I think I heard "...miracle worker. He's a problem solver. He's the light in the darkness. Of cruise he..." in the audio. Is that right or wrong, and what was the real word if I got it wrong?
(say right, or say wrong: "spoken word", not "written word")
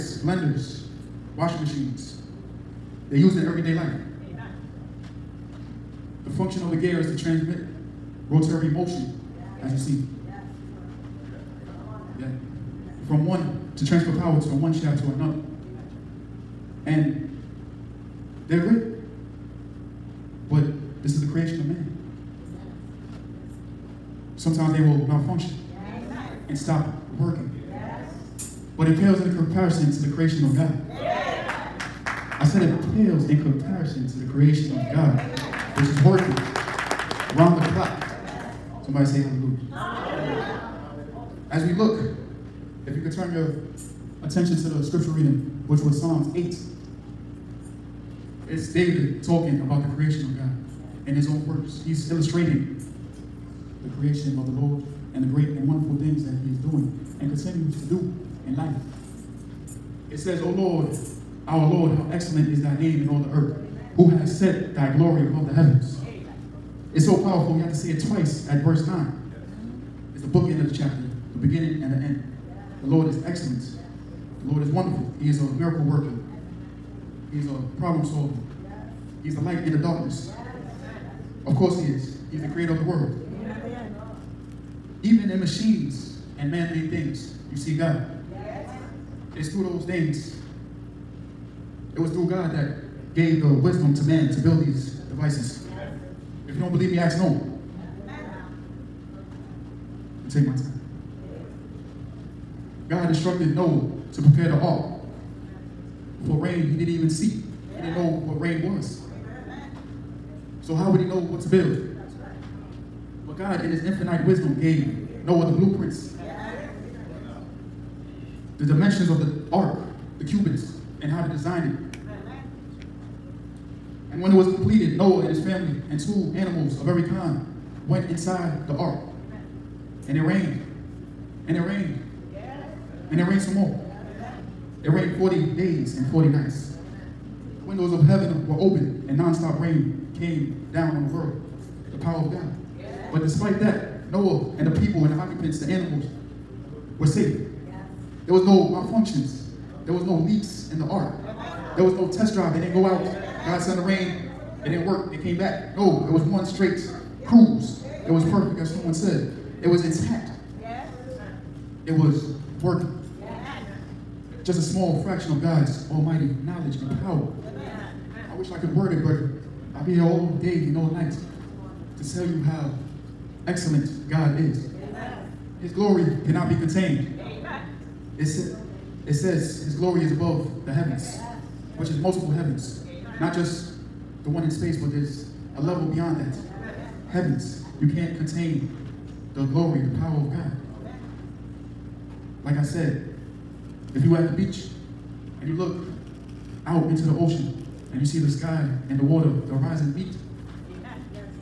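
wrong: "course", not "cruise".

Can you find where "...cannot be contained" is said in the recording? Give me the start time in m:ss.
2:56.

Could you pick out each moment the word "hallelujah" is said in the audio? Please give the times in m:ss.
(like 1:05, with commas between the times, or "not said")
0:39.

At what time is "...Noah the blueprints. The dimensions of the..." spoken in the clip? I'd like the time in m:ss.
1:55.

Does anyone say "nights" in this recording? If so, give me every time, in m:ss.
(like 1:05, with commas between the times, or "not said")
2:16, 2:50.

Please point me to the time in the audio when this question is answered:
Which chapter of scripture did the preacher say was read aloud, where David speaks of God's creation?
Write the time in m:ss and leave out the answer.
0:46.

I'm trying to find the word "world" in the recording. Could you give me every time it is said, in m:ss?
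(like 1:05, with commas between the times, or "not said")
1:22, 2:21.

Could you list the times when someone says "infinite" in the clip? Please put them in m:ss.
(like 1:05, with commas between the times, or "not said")
1:53.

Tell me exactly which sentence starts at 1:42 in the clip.
God instructed Noah to prepare the ark for rain he didn't even see.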